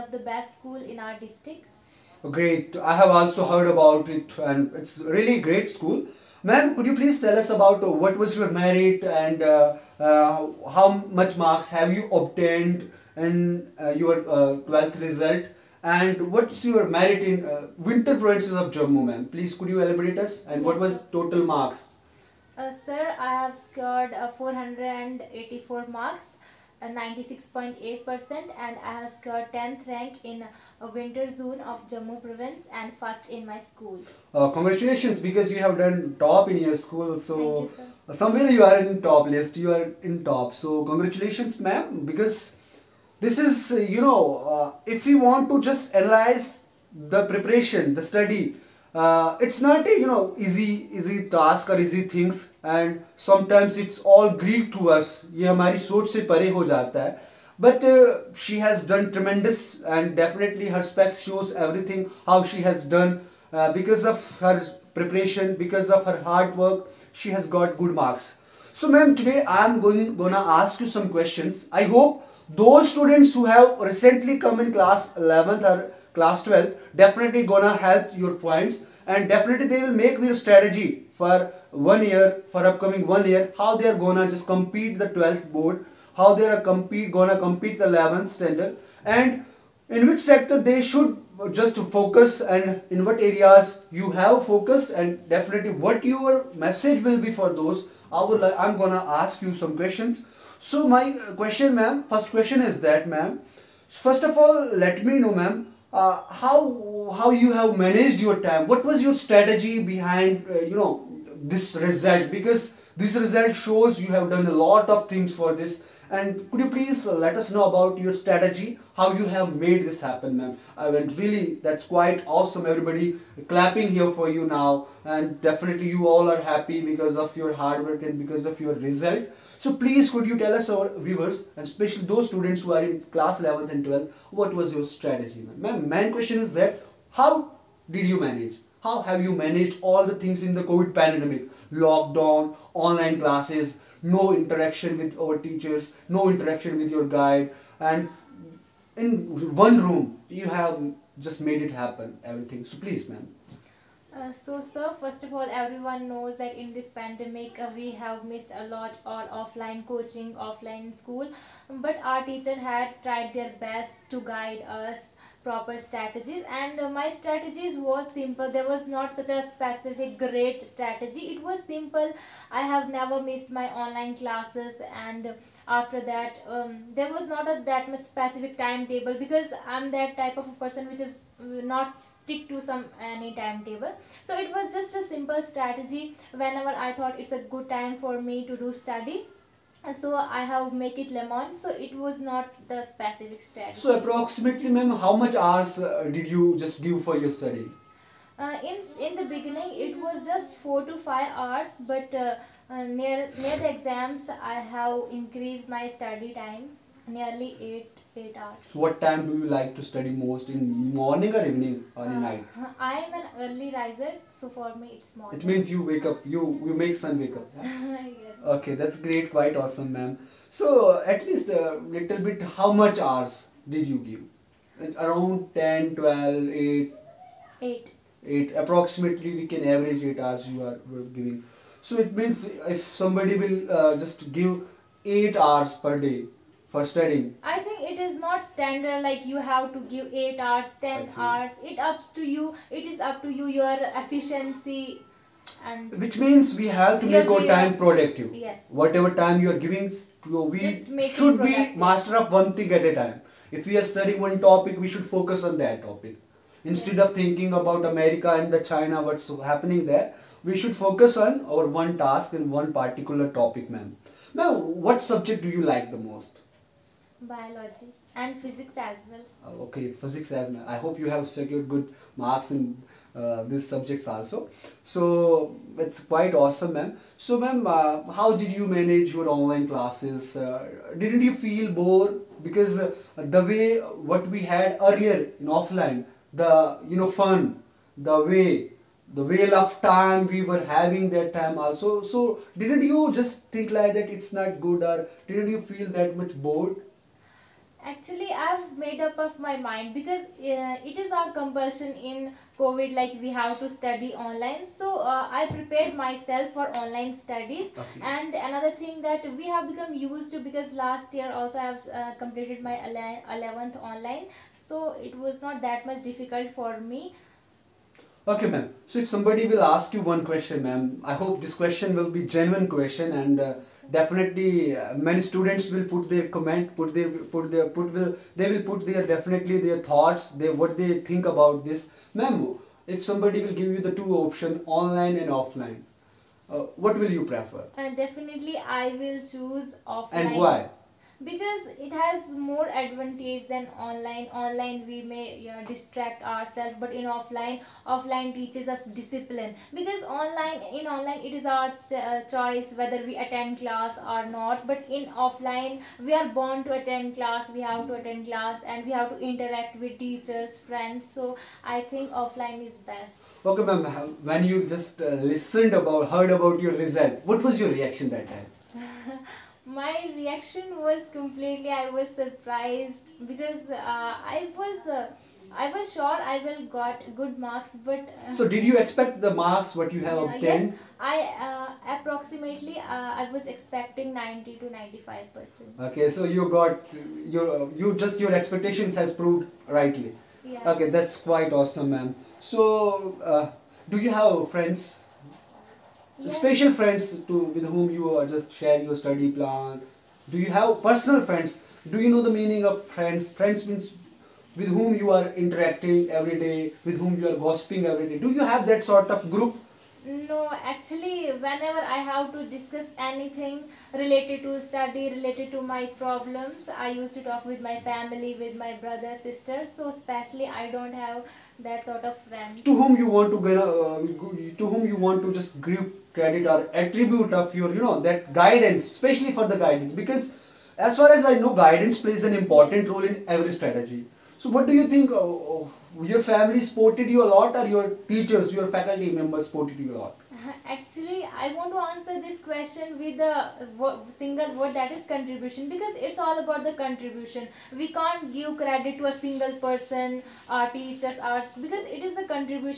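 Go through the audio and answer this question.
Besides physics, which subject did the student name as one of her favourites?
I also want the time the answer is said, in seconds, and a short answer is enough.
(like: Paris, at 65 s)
Biology, at 267 s.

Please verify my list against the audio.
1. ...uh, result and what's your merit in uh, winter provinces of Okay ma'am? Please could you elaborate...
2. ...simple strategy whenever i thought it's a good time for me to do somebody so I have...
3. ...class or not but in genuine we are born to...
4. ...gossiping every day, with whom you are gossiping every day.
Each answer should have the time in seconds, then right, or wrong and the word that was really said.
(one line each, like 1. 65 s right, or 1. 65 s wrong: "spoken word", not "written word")
1. 14 s wrong: "Jammu", not "Okay"
2. 185 s wrong: "study", not "somebody"
3. 353 s wrong: "offline", not "genuine"
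4. 405 s wrong: "interacting", not "gossiping".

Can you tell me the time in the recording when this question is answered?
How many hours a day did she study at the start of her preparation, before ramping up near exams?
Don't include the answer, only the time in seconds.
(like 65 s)
200 s.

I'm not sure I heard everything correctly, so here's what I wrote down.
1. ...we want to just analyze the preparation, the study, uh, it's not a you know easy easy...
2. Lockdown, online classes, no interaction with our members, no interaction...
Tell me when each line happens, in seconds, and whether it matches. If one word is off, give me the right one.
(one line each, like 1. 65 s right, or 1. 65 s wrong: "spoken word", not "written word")
1. 45 s right
2. 141 s wrong: "teachers", not "members".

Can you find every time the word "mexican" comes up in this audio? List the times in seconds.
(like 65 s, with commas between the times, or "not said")
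not said.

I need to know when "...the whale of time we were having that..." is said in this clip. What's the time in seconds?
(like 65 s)
289 s.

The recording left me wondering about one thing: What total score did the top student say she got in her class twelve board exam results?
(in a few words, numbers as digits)
484.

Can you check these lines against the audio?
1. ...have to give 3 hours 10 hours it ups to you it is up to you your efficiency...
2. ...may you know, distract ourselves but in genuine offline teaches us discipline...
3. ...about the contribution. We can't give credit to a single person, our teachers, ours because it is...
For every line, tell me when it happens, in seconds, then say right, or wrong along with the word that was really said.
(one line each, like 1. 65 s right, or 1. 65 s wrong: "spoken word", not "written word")
1. 239 s wrong: "8", not "3"
2. 345 s wrong: "offline", not "genuine"
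3. 446 s right.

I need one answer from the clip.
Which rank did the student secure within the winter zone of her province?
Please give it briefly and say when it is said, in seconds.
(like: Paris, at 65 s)
10th, at 29 s.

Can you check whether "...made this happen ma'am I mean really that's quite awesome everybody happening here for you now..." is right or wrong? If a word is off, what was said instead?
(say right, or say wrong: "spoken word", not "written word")
wrong: "clapping", not "happening".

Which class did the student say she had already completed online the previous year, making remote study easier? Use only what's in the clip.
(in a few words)
11th.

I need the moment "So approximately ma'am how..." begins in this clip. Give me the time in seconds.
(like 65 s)
193 s.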